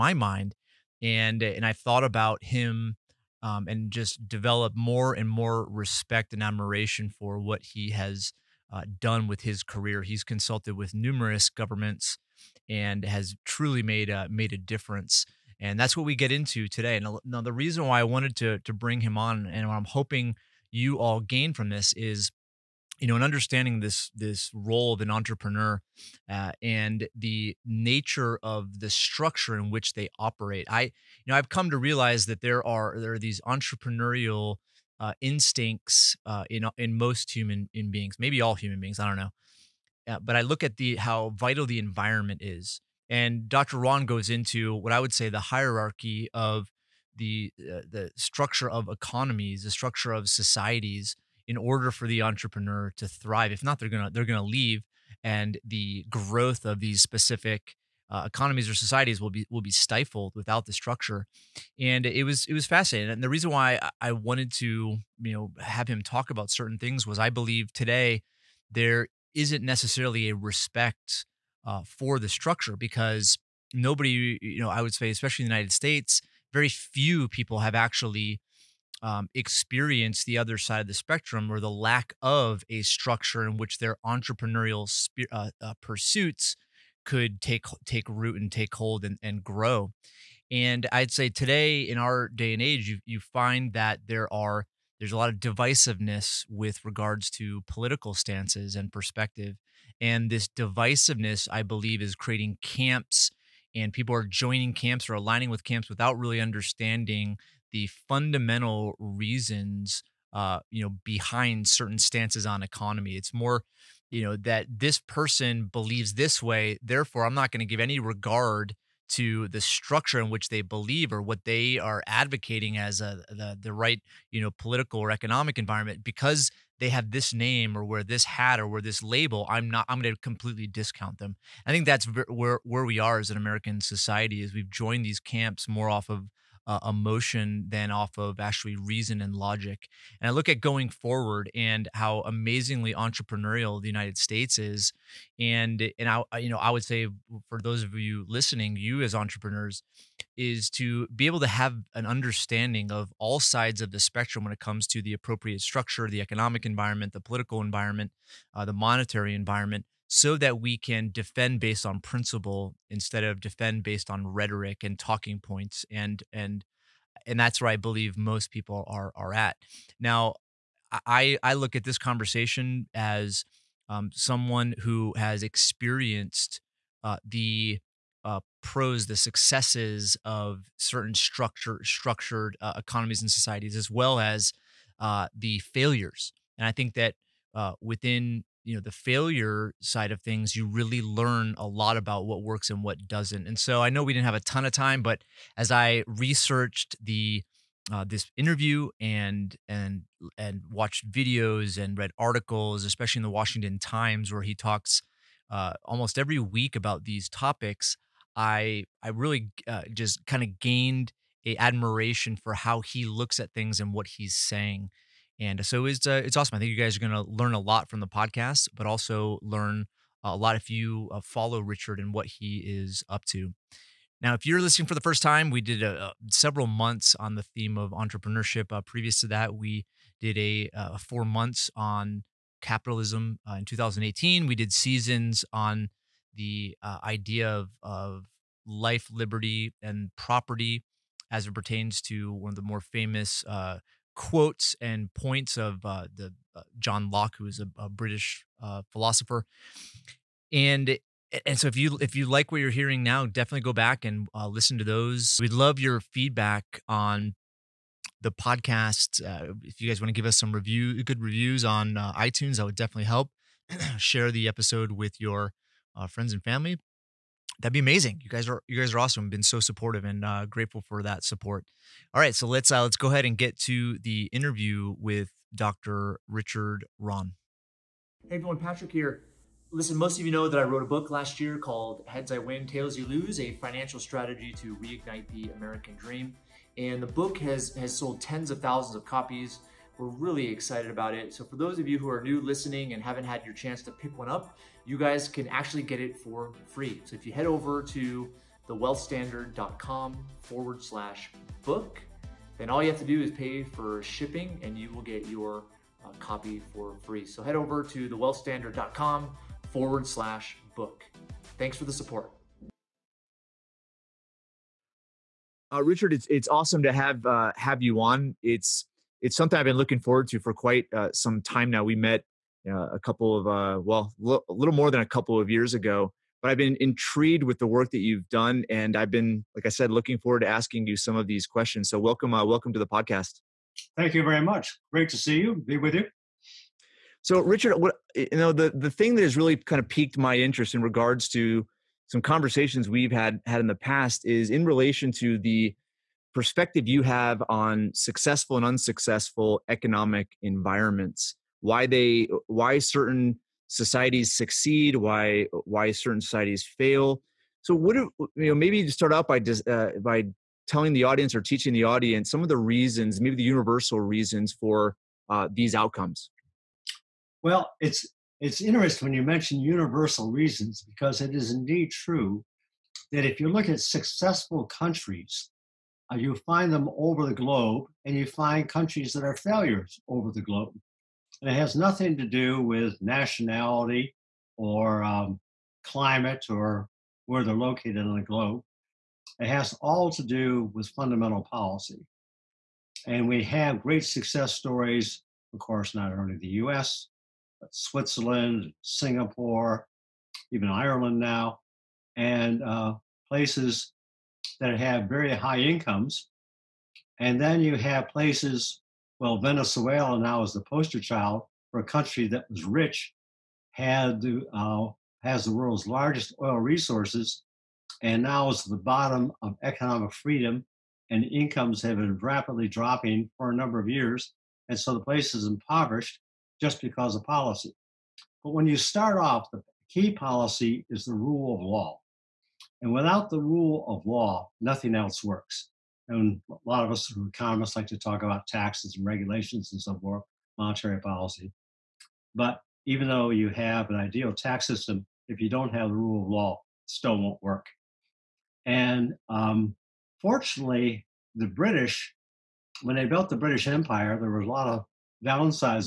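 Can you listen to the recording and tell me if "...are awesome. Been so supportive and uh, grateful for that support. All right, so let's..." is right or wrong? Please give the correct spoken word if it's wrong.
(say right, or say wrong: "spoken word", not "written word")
right.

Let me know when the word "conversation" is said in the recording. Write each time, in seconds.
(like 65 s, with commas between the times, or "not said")
171 s, 342 s.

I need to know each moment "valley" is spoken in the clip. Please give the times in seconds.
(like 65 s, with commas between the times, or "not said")
not said.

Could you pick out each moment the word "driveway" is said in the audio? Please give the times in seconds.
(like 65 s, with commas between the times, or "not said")
not said.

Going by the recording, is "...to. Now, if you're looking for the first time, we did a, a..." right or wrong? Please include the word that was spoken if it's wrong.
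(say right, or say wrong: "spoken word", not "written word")
wrong: "listening", not "looking".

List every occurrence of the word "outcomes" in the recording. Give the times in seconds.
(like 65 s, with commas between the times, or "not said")
365 s.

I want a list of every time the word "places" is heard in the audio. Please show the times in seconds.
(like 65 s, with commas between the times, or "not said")
403 s, 408 s, 425 s.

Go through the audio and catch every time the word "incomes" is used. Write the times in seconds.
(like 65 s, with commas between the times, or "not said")
405 s, 421 s.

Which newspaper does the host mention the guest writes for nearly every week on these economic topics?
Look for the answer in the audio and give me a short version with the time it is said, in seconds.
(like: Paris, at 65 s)
Washington Times, at 203 s.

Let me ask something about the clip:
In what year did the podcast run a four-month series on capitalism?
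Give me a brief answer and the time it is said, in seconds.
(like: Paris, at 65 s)
2018, at 233 s.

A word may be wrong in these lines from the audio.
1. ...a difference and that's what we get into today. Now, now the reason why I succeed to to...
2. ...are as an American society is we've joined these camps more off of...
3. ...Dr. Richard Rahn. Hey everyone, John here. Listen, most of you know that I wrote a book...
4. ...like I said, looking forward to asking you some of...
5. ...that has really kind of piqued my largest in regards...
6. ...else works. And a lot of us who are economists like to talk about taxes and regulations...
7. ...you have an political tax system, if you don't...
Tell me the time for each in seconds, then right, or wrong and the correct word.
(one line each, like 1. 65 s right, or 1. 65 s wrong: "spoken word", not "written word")
1. 14 s wrong: "wanted", not "succeed"
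2. 132 s right
3. 275 s wrong: "Patrick", not "John"
4. 329 s right
5. 339 s wrong: "interest", not "largest"
6. 434 s right
7. 443 s wrong: "ideal", not "political".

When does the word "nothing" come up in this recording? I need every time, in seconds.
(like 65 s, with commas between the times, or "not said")
381 s, 434 s.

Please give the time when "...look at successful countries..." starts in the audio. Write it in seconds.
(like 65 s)
373 s.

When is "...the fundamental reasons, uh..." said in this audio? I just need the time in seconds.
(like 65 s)
107 s.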